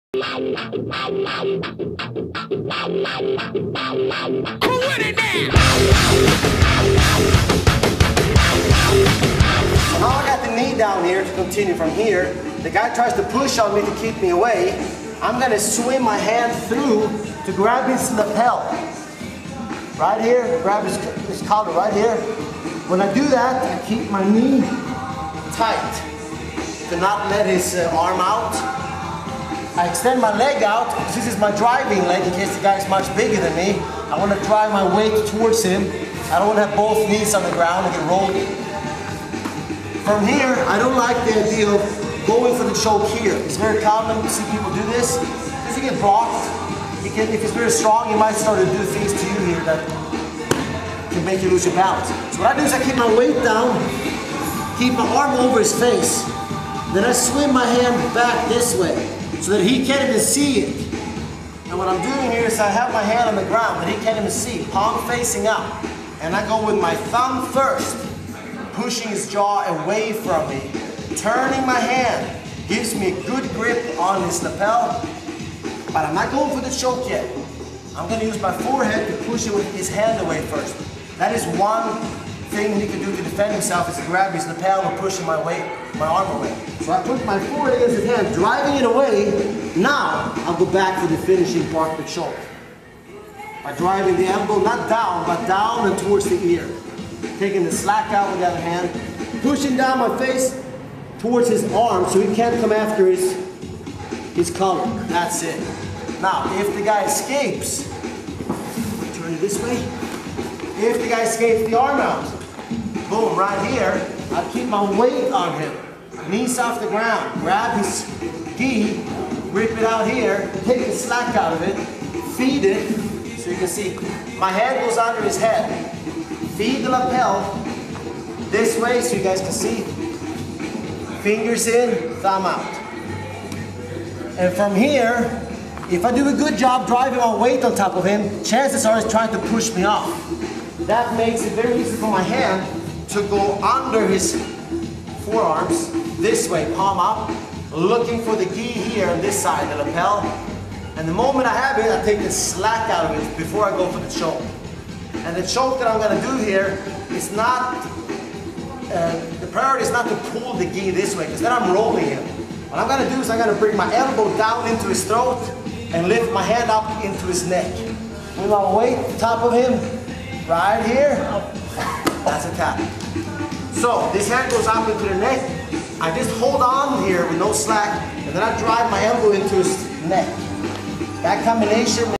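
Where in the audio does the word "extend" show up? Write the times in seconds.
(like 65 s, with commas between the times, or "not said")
29 s.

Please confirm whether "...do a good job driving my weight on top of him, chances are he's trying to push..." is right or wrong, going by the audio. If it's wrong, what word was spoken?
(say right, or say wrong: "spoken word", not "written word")
right.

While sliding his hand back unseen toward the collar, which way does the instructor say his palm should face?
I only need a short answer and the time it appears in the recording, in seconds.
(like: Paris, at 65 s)
Palm up, at 64 s.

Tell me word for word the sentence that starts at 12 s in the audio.
The guy tries to push on me to keep me away.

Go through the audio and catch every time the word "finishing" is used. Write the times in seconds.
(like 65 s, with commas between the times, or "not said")
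91 s.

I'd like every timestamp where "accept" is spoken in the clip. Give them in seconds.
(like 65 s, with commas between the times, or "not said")
not said.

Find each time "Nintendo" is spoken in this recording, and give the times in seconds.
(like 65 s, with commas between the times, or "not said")
not said.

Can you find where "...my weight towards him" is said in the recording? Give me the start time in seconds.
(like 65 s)
34 s.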